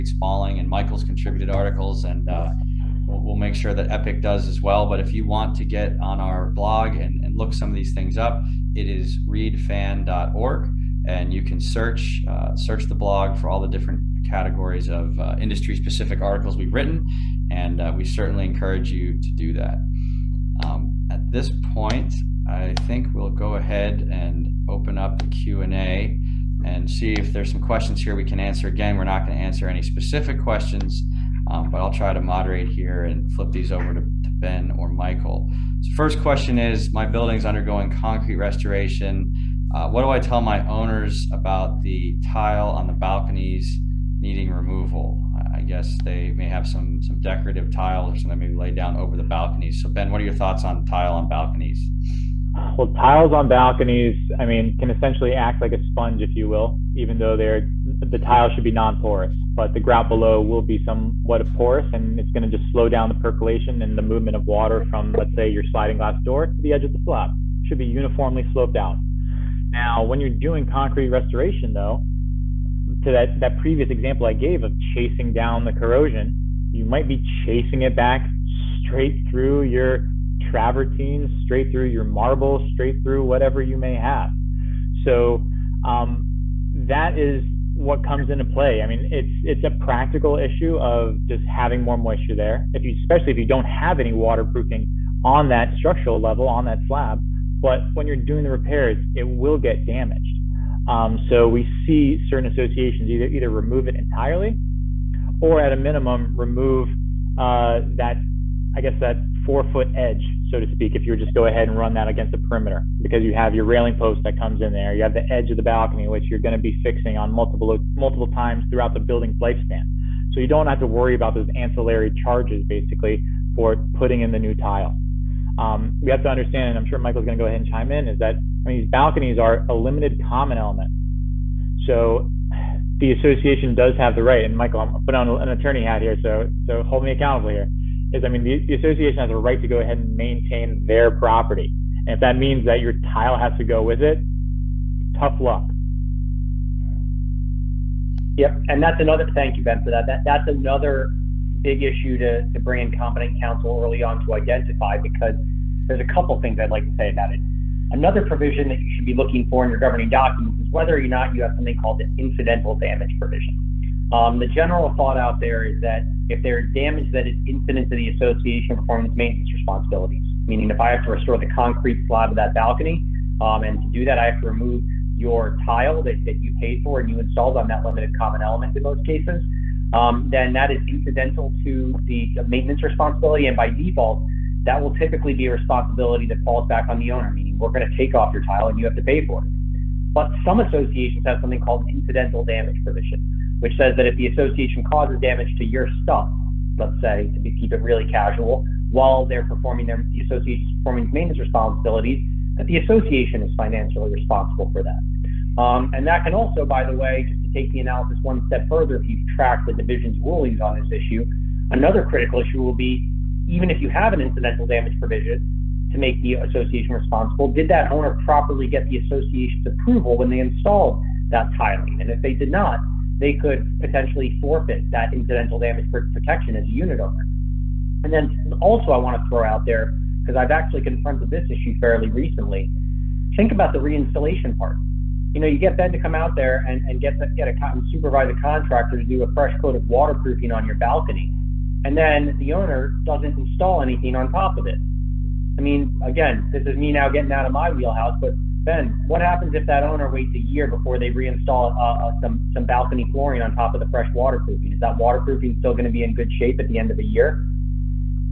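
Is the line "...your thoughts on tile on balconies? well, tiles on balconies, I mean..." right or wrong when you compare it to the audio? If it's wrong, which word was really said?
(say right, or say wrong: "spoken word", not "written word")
right.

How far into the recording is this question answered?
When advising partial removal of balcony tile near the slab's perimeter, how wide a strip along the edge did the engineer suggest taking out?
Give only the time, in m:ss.
1:49.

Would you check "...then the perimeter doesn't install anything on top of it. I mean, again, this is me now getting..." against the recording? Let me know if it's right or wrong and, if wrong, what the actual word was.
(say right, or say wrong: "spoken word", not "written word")
wrong: "owner", not "perimeter".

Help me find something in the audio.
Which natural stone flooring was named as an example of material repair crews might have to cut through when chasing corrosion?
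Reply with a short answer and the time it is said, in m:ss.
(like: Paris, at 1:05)
Travertine, at 1:20.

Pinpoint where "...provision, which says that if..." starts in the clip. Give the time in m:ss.
3:12.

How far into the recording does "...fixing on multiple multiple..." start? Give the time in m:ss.
1:56.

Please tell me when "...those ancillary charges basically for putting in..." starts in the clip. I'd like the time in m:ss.
2:01.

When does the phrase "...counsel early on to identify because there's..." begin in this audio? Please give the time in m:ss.
2:33.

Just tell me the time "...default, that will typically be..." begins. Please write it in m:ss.
3:03.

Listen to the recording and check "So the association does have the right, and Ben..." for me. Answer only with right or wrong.
wrong.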